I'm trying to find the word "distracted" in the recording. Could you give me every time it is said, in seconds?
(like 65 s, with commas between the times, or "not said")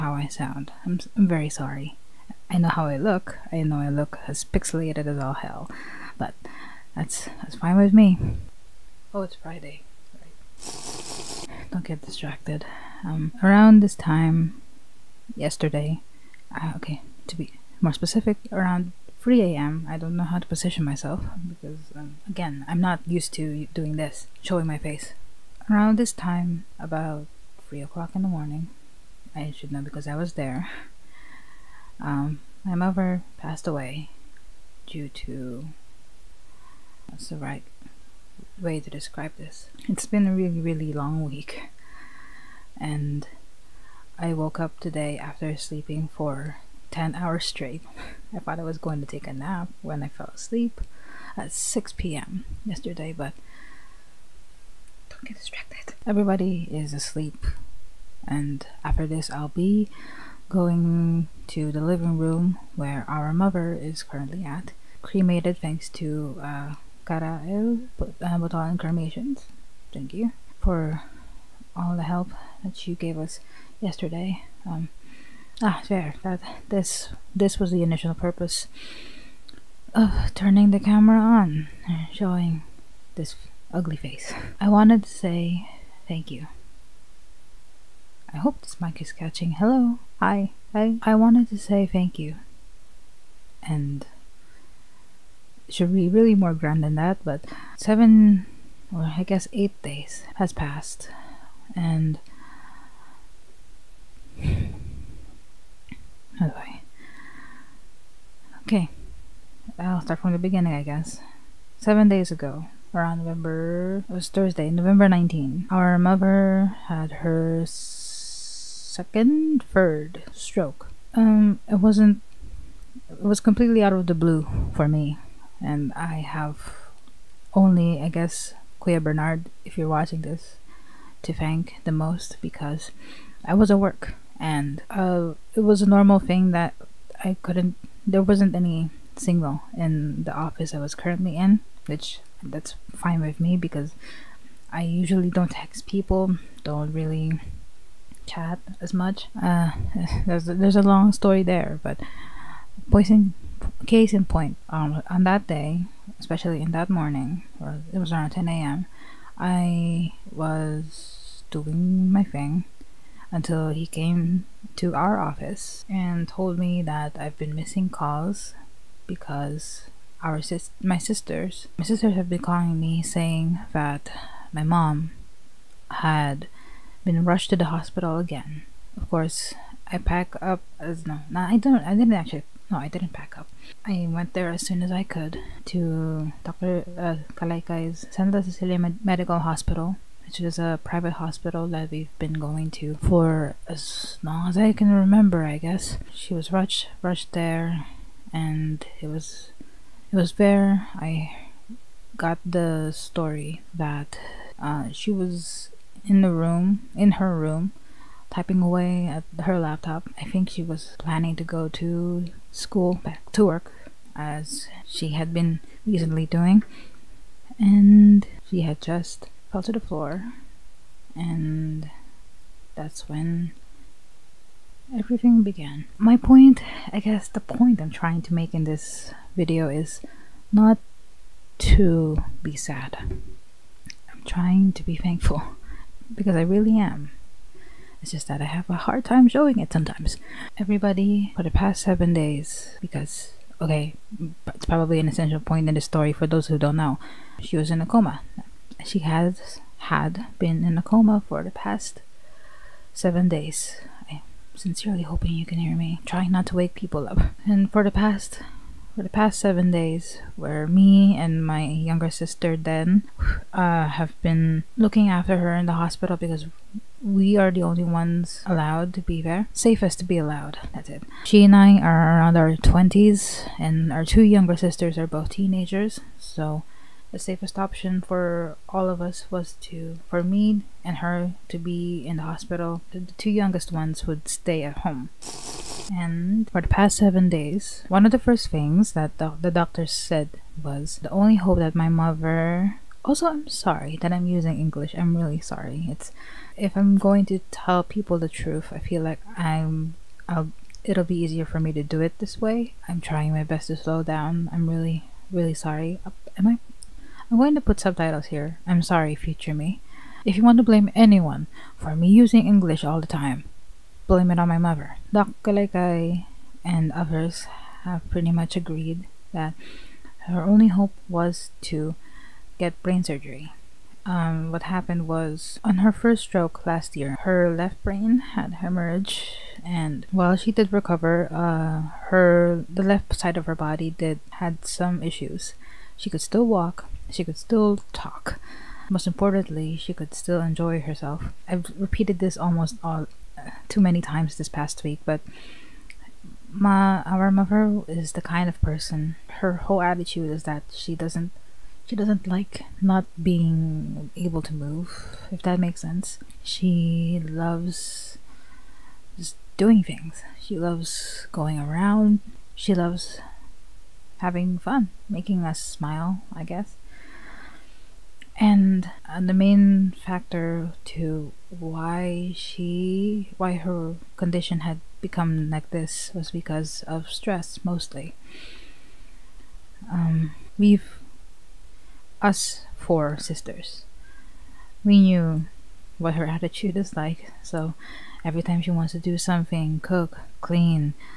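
12 s, 55 s.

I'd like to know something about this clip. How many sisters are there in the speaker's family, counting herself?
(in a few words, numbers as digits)
4.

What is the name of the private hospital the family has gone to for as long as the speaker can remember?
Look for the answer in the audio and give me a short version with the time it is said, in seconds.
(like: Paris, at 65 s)
Santa Cecilia, at 188 s.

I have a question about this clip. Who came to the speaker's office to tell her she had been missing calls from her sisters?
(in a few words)
Kuya Bernard.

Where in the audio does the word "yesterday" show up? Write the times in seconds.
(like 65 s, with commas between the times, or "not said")
15 s, 52 s, 73 s.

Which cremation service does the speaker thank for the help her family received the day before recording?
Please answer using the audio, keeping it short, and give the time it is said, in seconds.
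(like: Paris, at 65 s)
Karael Botolan Cremations, at 67 s.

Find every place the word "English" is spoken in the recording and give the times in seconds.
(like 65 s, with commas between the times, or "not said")
294 s, 312 s.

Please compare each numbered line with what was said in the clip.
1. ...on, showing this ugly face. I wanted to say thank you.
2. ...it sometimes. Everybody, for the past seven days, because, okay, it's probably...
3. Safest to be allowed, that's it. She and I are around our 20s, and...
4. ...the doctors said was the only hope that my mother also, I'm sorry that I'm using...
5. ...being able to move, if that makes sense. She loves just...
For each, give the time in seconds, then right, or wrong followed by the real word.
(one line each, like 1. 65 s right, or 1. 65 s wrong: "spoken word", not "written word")
1. 81 s right
2. 239 s right
3. 269 s right
4. 289 s right
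5. 353 s right.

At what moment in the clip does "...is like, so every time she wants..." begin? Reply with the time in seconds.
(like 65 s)
386 s.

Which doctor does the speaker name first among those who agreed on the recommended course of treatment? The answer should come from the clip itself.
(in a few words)
Doc Kalekai.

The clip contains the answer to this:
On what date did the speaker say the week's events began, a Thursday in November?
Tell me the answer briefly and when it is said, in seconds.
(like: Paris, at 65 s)
November 19, at 114 s.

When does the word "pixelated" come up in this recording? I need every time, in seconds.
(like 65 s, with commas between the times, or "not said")
4 s.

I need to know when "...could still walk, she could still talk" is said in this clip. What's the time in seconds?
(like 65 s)
336 s.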